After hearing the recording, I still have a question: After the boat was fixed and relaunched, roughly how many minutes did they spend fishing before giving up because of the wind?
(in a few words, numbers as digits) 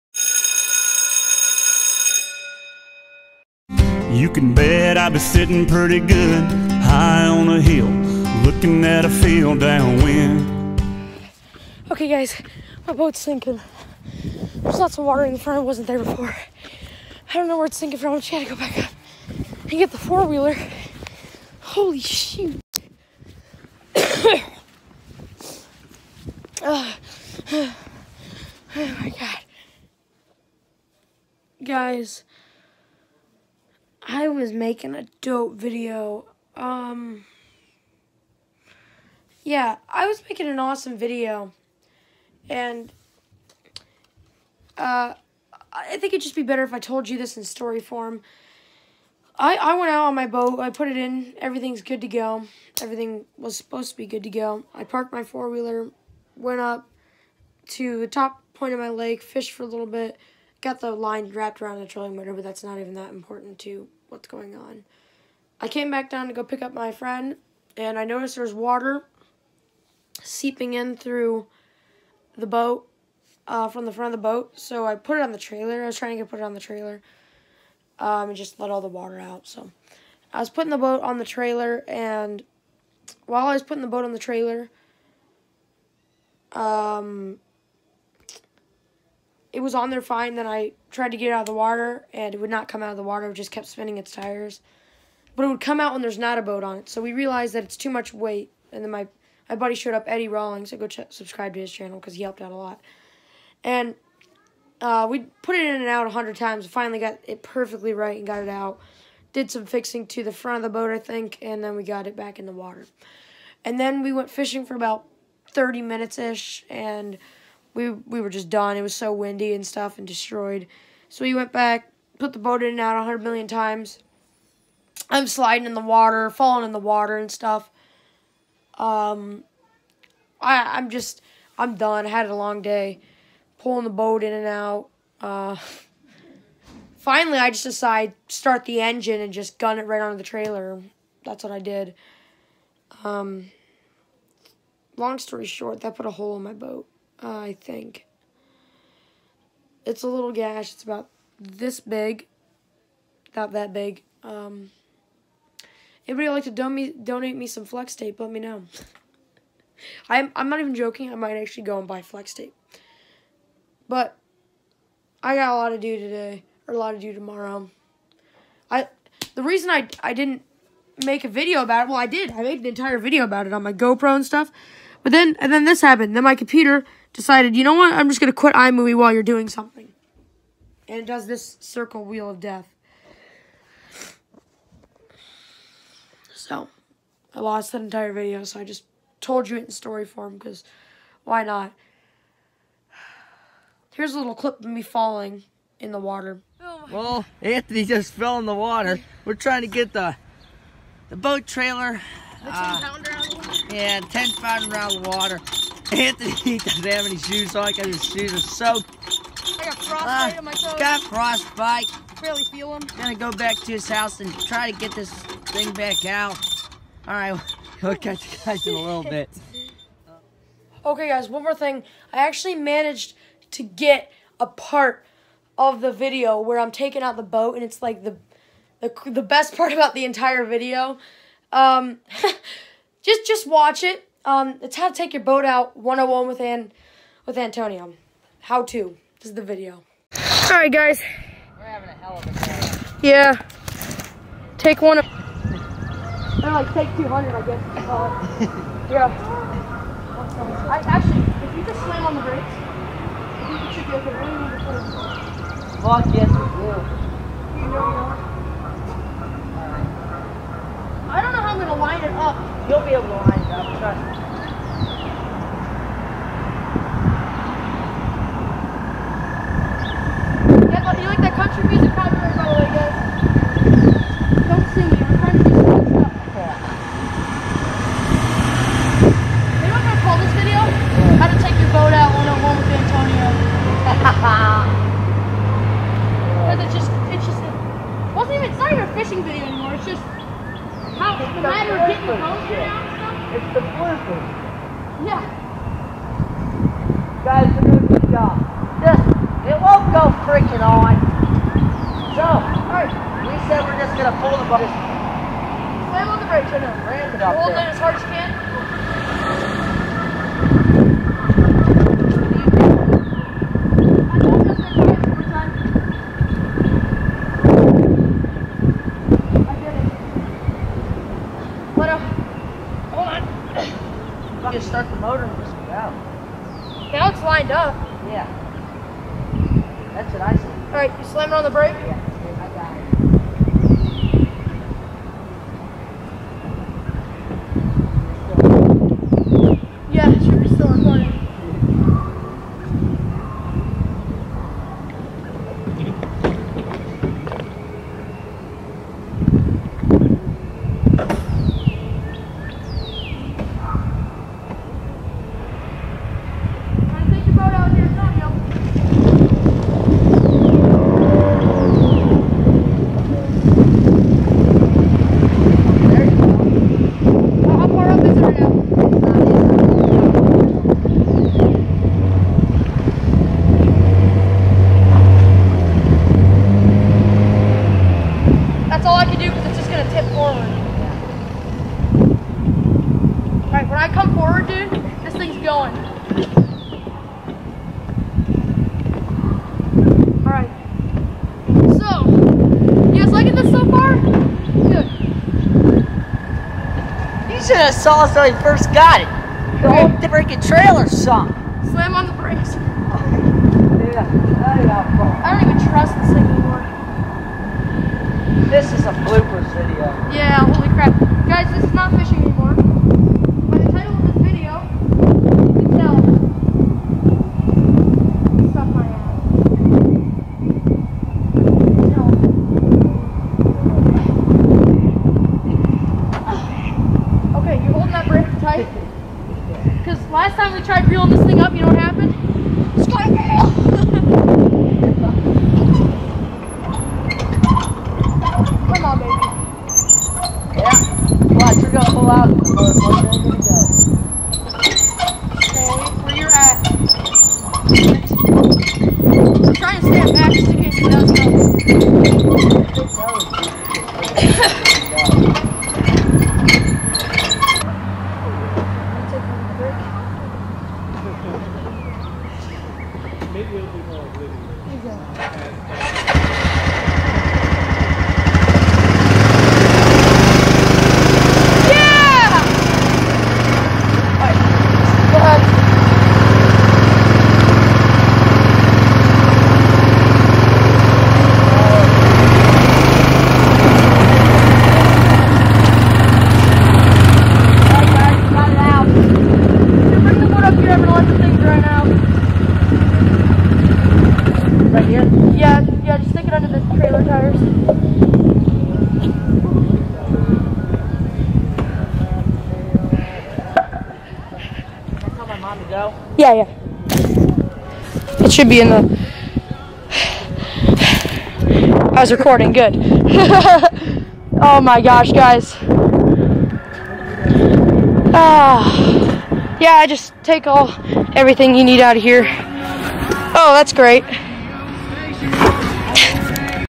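30.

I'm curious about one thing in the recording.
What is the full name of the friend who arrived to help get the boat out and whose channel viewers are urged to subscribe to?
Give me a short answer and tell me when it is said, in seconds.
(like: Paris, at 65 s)
Eddie Rawlings, at 100 s.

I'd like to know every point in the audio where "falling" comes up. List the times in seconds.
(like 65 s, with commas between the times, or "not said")
126 s, 194 s.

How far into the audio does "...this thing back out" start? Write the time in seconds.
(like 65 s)
214 s.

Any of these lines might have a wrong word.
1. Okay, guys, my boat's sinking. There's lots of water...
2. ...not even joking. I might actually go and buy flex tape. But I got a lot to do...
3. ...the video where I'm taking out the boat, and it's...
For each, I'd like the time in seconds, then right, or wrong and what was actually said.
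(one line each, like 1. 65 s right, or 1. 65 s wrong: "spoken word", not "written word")
1. 11 s right
2. 160 s right
3. 225 s right.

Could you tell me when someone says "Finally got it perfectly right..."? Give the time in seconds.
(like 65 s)
106 s.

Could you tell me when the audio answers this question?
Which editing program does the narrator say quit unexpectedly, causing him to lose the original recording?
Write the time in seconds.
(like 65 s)
178 s.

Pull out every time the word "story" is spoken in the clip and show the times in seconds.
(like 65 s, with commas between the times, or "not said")
47 s, 145 s, 189 s.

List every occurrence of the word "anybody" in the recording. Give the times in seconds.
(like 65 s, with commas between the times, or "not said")
156 s.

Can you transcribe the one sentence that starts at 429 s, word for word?
Because last time we tried reeling this thing up, you know what happened?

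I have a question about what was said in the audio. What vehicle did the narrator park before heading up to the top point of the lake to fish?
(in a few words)
Four-wheeler.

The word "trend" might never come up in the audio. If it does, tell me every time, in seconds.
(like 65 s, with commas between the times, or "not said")
not said.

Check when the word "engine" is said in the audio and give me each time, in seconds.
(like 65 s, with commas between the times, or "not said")
138 s.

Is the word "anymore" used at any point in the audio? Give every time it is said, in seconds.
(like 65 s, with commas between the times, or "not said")
406 s, 412 s.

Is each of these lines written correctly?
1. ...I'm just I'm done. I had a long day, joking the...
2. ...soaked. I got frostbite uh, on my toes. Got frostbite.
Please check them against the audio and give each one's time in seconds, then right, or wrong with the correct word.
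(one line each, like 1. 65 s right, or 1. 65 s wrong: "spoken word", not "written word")
1. 130 s wrong: "pulling", not "joking"
2. 208 s right.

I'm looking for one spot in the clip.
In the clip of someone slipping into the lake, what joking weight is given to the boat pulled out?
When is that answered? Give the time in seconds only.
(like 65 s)
203 s.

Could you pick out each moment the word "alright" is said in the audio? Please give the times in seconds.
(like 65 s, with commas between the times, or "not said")
302 s, 383 s, 390 s.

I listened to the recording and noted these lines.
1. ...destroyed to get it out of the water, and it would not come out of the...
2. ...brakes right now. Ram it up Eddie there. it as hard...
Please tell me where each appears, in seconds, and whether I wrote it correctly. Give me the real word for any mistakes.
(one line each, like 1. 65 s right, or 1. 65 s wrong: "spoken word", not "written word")
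1. 90 s wrong: "tried", not "destroyed"
2. 306 s wrong: "Hold", not "Eddie".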